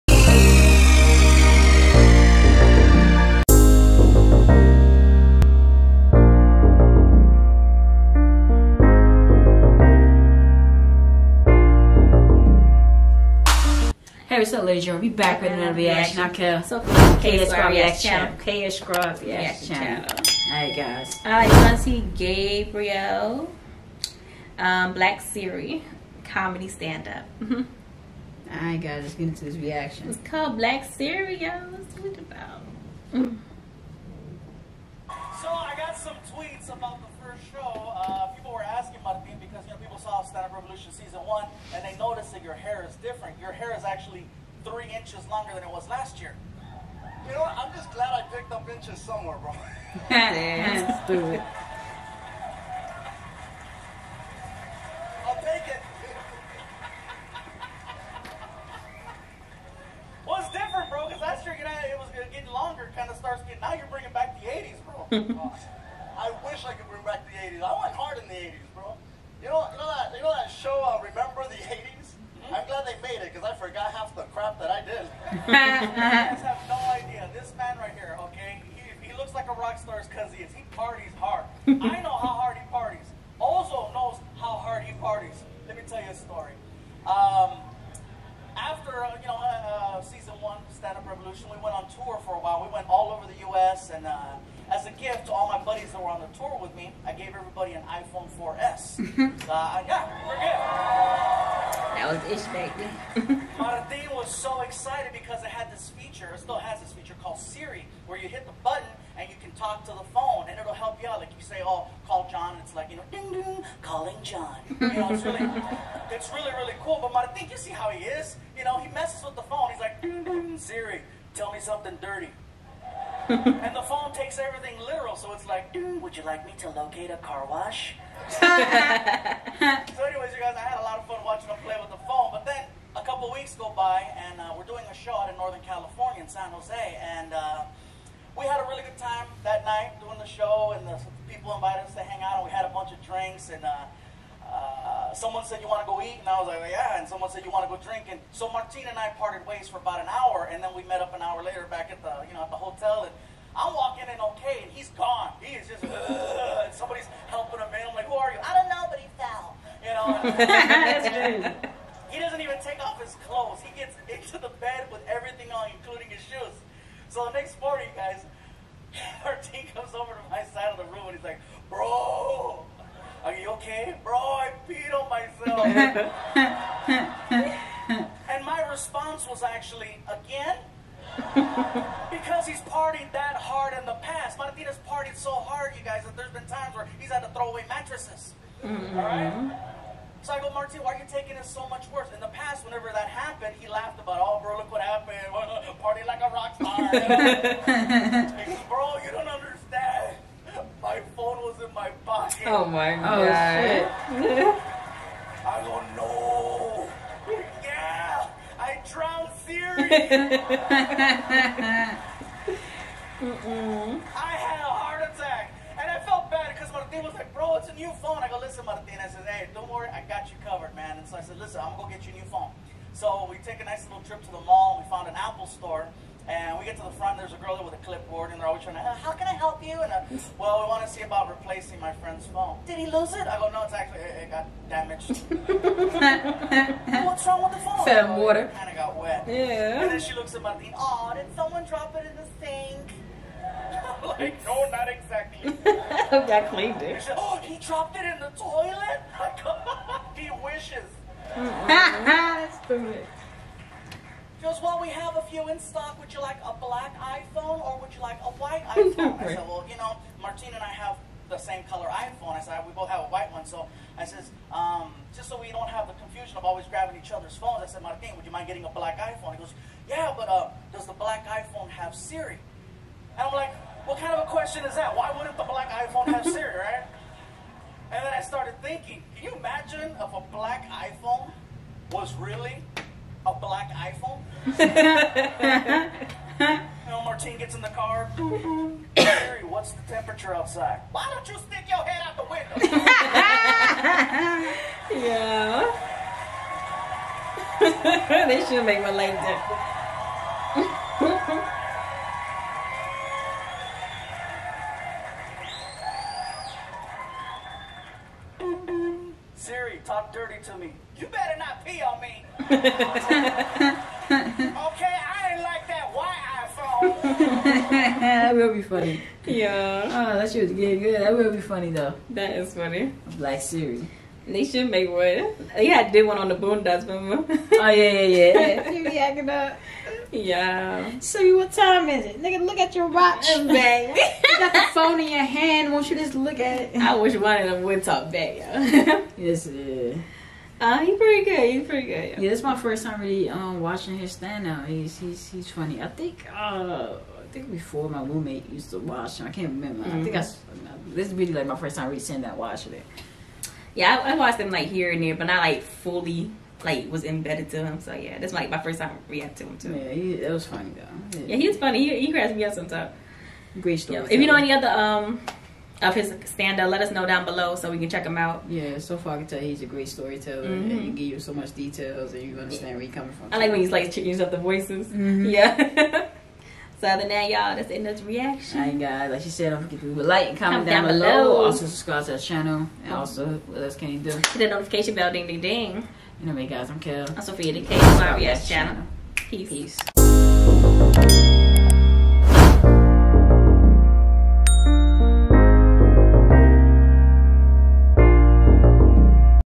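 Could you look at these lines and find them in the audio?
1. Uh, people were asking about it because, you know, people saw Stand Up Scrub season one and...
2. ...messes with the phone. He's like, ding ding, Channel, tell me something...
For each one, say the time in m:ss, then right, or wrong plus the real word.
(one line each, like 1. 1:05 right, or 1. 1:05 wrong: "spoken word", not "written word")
1. 0:37 wrong: "Revolution", not "Scrub"
2. 1:58 wrong: "Siri", not "Channel".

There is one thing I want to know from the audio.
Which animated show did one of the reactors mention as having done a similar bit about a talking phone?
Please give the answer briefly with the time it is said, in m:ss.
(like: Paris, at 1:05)
The Boondocks, at 5:26.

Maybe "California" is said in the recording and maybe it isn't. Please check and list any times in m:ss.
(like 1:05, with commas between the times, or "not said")
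2:15.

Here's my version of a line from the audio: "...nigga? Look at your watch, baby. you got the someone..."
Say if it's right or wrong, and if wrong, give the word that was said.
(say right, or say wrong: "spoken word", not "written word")
wrong: "phone", not "someone".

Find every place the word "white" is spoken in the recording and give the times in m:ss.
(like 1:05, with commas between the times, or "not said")
4:18, 4:23, 5:15.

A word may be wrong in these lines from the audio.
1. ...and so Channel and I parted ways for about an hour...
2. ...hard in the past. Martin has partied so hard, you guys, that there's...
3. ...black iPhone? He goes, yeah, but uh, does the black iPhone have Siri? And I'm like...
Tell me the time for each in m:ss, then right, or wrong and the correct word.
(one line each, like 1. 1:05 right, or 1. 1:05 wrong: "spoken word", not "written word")
1. 2:28 wrong: "Martine", not "Channel"
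2. 3:03 right
3. 4:28 right.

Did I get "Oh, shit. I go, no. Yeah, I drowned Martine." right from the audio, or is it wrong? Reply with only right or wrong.
wrong.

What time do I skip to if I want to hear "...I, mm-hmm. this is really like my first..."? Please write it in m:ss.
5:50.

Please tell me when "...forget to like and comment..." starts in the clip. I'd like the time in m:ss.
6:19.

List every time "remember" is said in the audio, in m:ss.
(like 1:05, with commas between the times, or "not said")
5:26, 5:49.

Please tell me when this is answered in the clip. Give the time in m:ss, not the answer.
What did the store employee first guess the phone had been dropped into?
4:02.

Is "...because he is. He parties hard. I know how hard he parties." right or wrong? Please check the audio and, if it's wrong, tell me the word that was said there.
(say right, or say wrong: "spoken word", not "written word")
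right.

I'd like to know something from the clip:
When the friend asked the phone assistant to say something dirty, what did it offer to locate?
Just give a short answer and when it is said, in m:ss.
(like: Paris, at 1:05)
A car wash, at 2:07.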